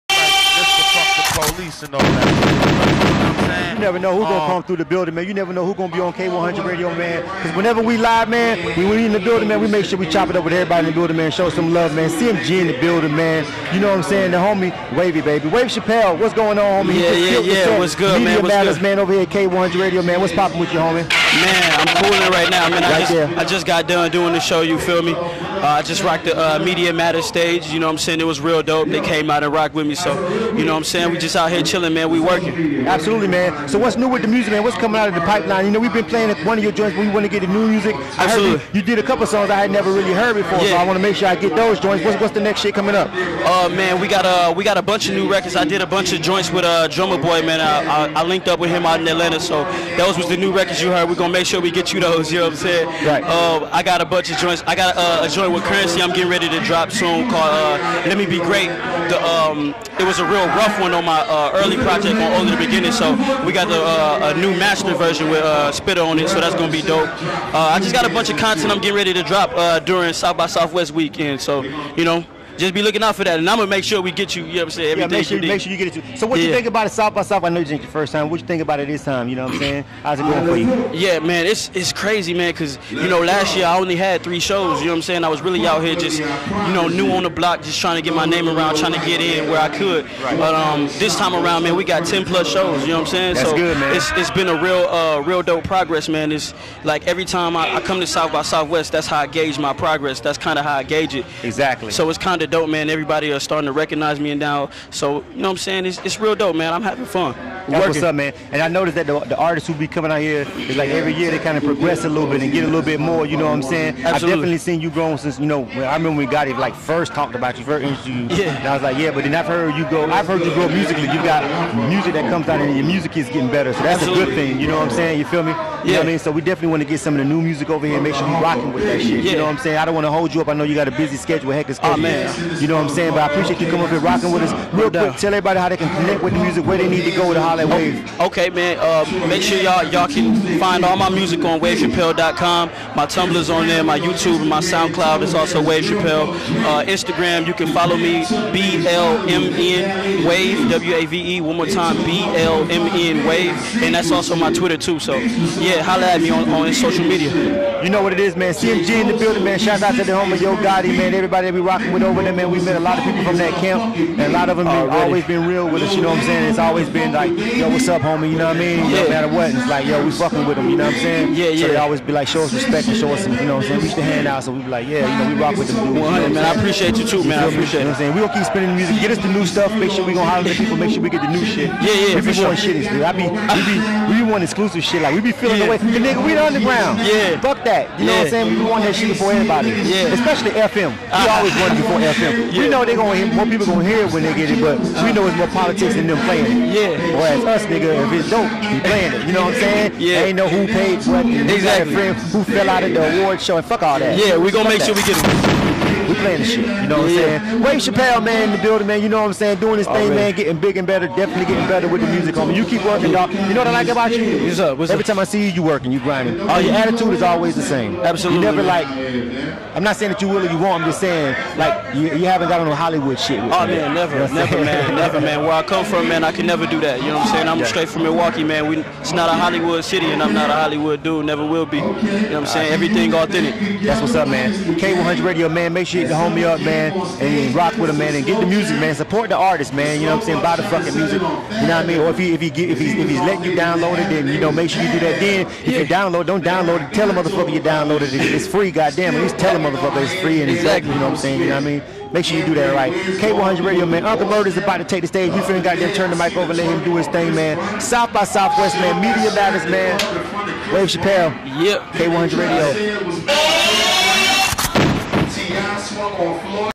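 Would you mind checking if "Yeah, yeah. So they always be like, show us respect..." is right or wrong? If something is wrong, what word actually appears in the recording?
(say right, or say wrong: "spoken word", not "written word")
right.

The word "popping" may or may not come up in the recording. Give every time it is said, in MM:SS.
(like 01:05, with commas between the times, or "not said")
00:20.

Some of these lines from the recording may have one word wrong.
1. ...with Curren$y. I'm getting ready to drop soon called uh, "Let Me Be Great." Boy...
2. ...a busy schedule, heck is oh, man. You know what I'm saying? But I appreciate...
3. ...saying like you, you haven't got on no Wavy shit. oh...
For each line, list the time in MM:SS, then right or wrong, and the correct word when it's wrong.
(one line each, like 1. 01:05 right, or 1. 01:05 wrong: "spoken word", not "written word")
1. 00:55 wrong: "The", not "Boy"
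2. 02:10 right
3. 03:40 wrong: "Hollywood", not "Wavy".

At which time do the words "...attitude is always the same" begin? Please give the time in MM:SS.
03:36.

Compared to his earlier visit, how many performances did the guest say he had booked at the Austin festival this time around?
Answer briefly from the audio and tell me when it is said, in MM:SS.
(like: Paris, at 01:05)
10 plus, at 01:32.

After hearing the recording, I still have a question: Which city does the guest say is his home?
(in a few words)
Milwaukee.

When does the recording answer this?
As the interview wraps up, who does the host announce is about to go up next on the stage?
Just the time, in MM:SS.
04:14.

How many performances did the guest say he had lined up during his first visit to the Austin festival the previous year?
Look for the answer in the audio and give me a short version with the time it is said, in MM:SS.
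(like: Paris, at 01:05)
3, at 01:24.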